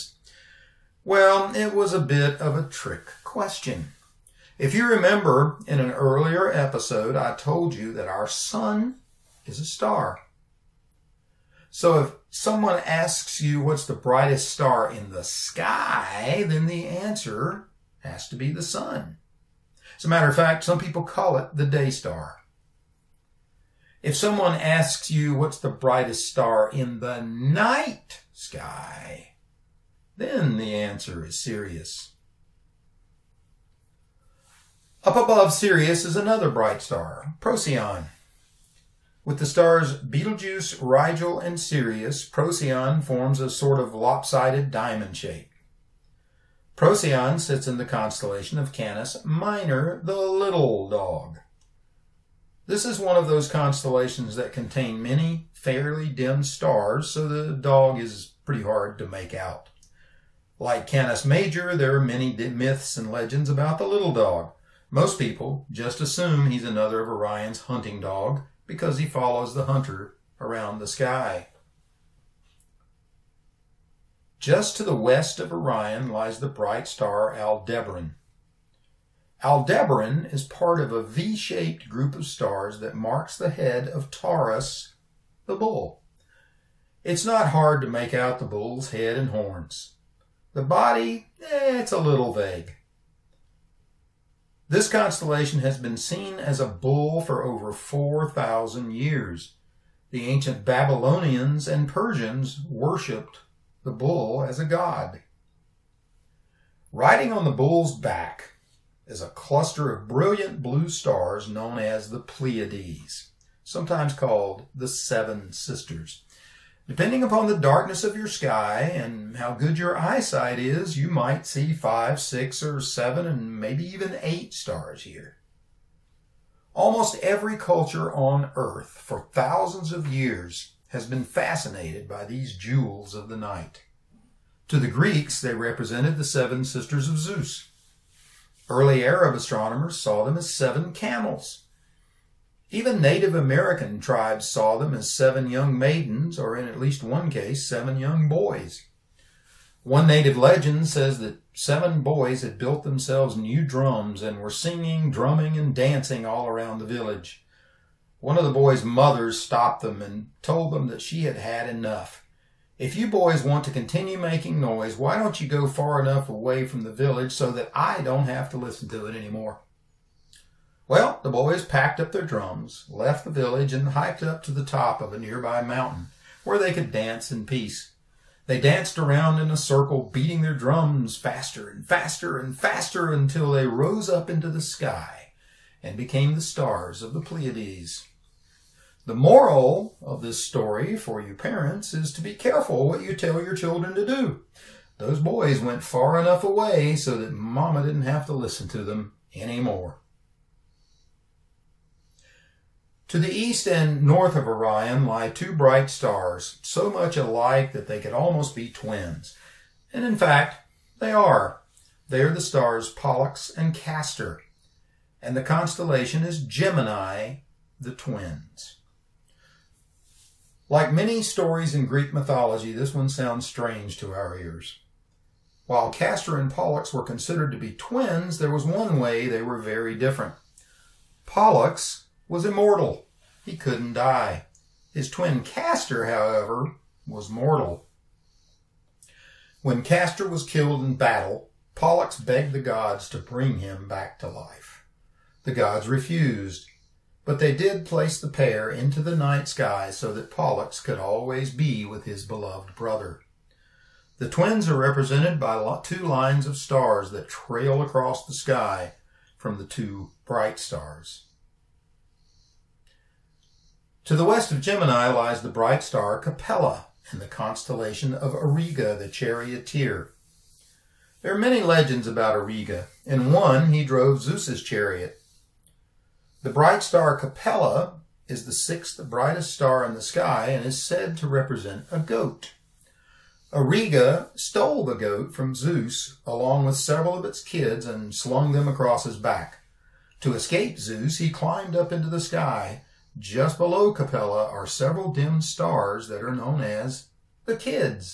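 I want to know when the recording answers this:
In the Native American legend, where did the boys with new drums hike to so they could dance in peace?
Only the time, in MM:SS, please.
02:55.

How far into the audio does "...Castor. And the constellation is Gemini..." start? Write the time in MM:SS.
03:33.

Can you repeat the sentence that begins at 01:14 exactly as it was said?
Just to the west of Orion lies the bright star Aldebaran.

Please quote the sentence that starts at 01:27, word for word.
It's not hard to make out the bull's head and horns.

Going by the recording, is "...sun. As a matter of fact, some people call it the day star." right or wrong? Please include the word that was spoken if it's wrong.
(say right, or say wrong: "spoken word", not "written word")
right.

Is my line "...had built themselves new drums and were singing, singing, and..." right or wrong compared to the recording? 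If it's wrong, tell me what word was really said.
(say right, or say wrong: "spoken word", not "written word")
wrong: "drumming", not "singing".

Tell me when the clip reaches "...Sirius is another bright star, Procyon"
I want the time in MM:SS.
00:35.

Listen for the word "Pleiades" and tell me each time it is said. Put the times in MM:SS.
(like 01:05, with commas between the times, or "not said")
01:52, 03:07.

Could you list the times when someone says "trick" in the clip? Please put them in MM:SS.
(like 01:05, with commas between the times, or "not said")
00:02.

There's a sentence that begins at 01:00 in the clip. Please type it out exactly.
Like Canis Major, there are many myths and legends about the little dog.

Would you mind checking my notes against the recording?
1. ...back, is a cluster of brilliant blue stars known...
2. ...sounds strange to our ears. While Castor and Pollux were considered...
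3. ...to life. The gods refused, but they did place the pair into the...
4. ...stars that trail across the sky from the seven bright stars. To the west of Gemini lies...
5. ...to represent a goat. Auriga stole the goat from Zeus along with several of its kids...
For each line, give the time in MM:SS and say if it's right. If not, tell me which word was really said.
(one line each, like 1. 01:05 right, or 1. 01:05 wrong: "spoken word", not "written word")
1. 01:47 right
2. 03:43 right
3. 04:04 right
4. 04:16 wrong: "two", not "seven"
5. 04:41 right.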